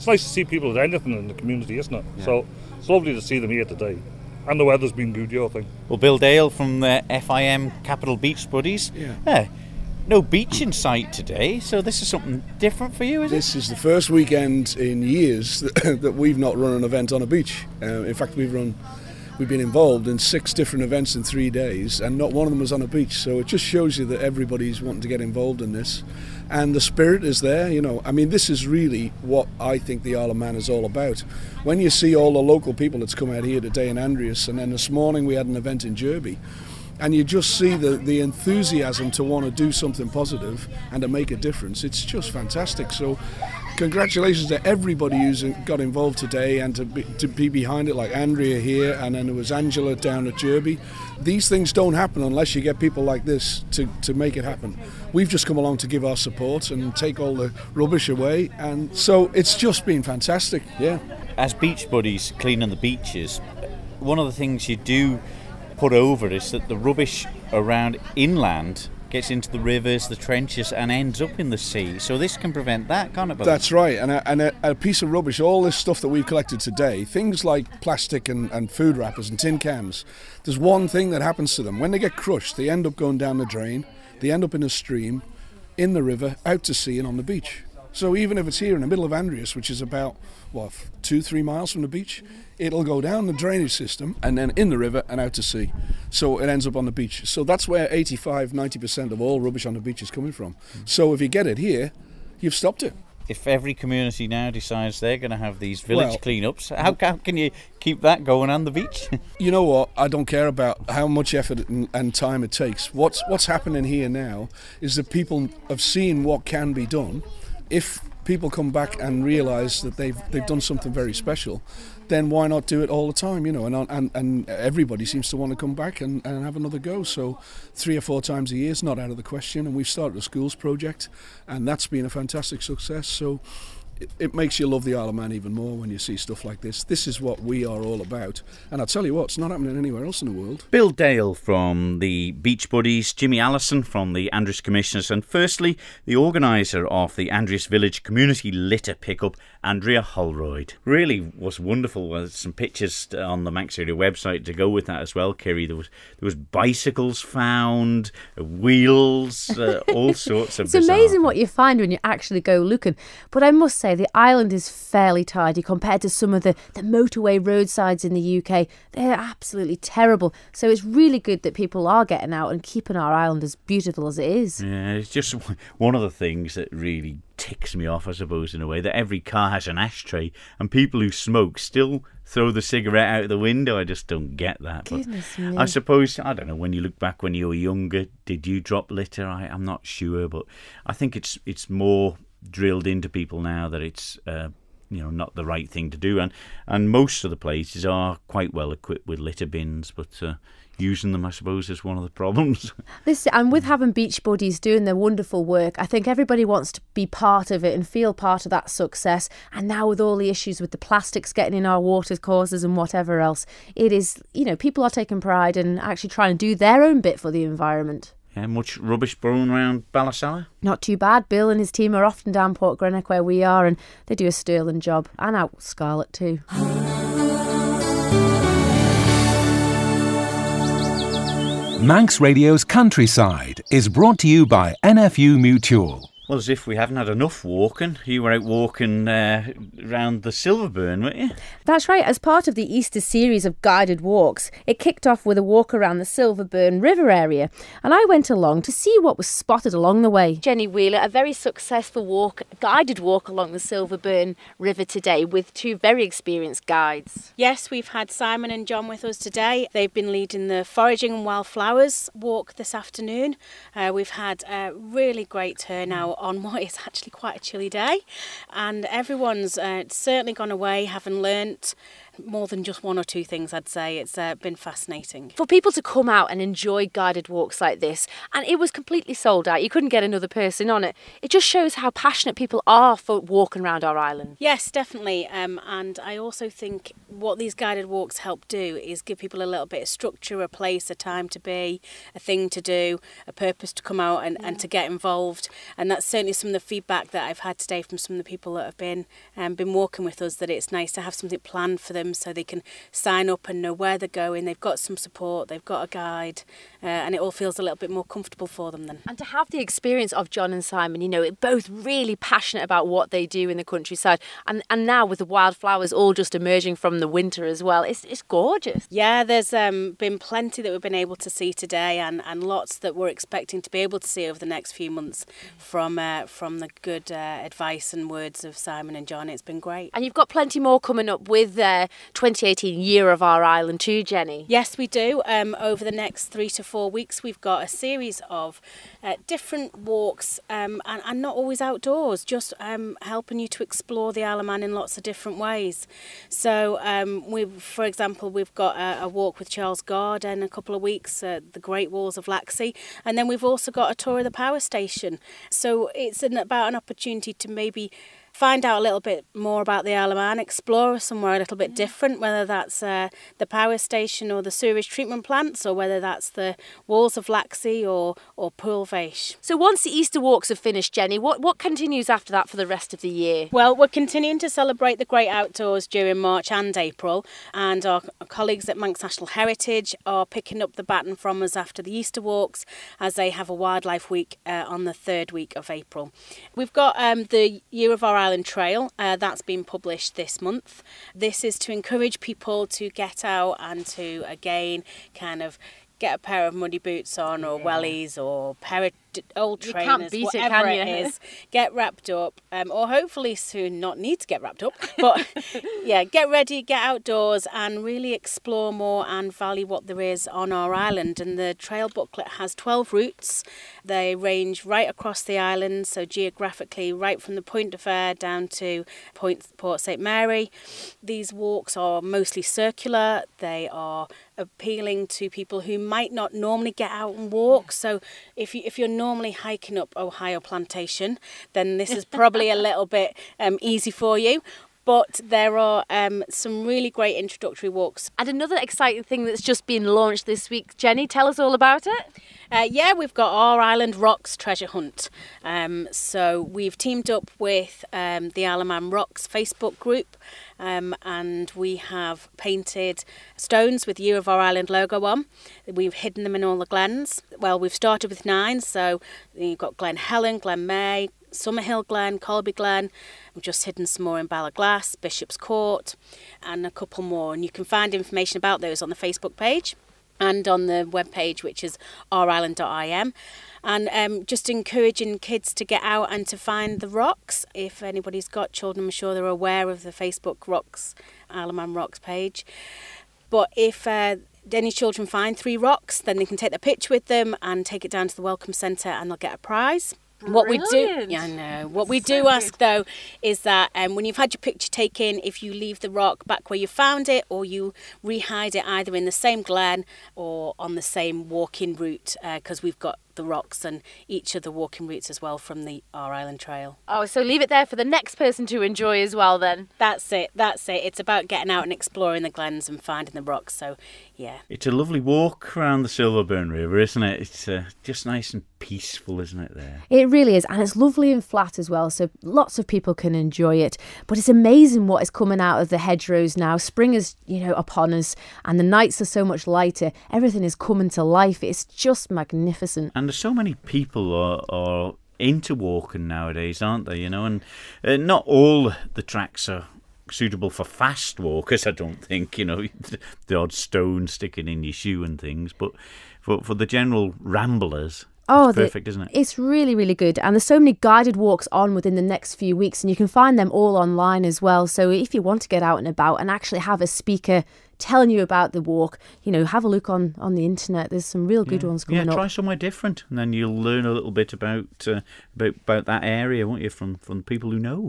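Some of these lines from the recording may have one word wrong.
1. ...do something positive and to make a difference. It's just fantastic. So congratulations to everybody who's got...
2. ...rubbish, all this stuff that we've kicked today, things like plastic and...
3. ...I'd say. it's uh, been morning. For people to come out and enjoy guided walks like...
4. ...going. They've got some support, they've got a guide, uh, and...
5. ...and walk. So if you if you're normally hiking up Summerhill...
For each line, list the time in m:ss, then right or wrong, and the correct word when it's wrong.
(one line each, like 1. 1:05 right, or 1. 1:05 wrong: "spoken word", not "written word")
1. 0:39 right
2. 1:15 wrong: "collected", not "kicked"
3. 4:33 wrong: "fascinating", not "morning"
4. 5:04 right
5. 7:07 wrong: "Ohio", not "Summerhill".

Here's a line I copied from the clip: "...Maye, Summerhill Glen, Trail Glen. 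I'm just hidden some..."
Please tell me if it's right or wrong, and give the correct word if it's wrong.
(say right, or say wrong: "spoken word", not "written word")
wrong: "Colby", not "Trail".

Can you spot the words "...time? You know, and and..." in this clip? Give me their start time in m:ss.
2:03.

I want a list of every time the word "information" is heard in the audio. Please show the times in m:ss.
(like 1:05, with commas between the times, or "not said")
7:47.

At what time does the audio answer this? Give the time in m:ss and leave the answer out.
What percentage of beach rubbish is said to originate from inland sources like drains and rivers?
1:37.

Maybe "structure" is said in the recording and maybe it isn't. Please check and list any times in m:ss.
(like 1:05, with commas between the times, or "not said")
4:49.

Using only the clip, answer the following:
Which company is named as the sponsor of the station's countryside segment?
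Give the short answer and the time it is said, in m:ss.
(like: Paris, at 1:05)
NFU Mutual, at 3:54.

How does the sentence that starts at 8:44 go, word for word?
But it's amazing what is coming out of the hedgerows now.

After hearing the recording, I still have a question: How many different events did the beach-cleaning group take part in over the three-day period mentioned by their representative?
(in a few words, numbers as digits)
6.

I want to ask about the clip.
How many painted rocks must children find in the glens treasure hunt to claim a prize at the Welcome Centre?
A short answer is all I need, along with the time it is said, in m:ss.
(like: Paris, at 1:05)
3, at 8:05.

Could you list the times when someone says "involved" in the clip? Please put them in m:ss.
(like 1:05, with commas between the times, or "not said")
0:19, 0:25, 0:45, 4:54.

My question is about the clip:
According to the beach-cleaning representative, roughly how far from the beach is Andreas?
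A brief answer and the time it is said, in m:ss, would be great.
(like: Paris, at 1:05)
2 to 3 miles, at 1:31.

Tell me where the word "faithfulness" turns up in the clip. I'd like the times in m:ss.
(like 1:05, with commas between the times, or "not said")
not said.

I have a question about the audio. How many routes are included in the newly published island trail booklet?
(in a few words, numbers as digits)
12.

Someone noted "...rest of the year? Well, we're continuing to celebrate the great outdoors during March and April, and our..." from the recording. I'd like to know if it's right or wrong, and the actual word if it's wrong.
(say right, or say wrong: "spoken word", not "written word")
right.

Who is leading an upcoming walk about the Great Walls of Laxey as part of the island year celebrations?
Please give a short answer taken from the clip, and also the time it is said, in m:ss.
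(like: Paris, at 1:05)
Charles Guard, at 5:49.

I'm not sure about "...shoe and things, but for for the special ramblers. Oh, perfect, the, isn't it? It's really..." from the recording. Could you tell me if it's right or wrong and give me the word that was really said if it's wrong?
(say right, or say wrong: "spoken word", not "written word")
wrong: "general", not "special".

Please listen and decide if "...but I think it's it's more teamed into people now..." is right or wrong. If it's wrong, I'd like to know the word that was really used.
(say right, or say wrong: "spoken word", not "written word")
wrong: "drilled", not "teamed".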